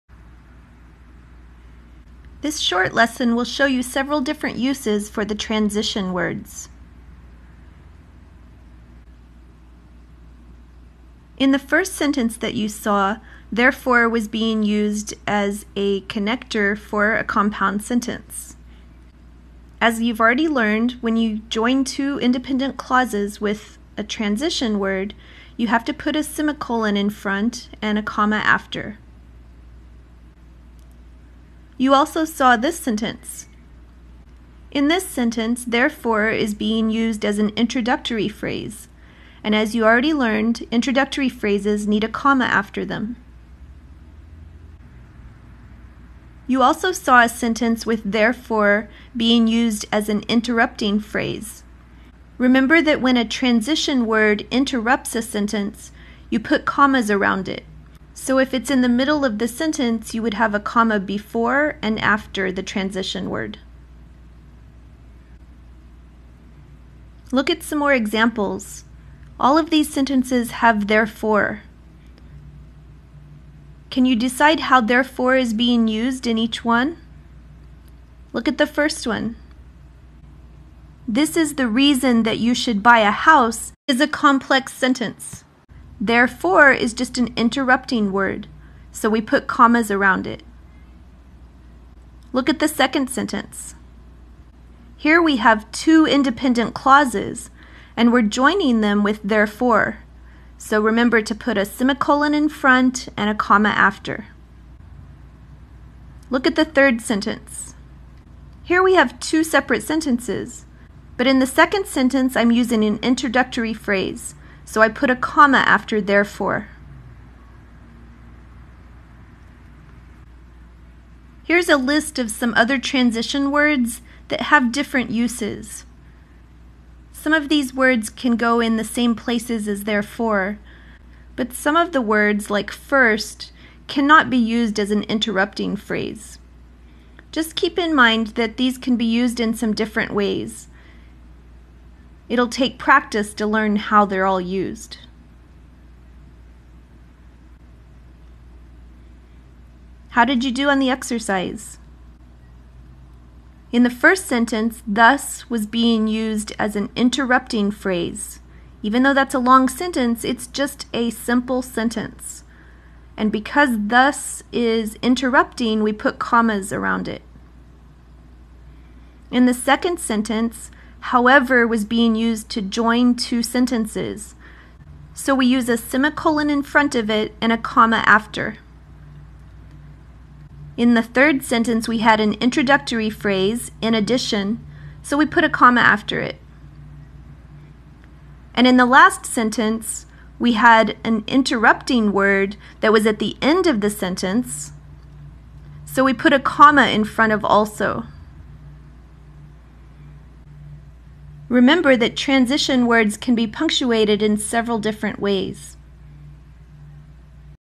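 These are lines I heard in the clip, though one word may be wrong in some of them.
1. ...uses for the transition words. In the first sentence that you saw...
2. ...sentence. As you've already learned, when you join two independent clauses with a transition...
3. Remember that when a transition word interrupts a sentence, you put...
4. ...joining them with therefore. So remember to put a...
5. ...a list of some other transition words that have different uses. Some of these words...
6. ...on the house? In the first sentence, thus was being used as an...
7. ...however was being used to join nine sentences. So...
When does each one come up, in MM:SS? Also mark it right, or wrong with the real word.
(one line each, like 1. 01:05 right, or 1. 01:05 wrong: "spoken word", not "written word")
1. 00:04 right
2. 00:17 right
3. 00:52 right
4. 01:38 right
5. 02:01 right
6. 02:30 wrong: "exercise", not "house"
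7. 02:51 wrong: "two", not "nine".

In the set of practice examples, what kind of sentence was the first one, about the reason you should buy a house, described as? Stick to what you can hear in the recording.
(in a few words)
complex sentence.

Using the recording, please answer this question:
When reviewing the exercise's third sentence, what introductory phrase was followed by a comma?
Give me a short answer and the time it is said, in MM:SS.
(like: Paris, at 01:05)
in addition, at 03:03.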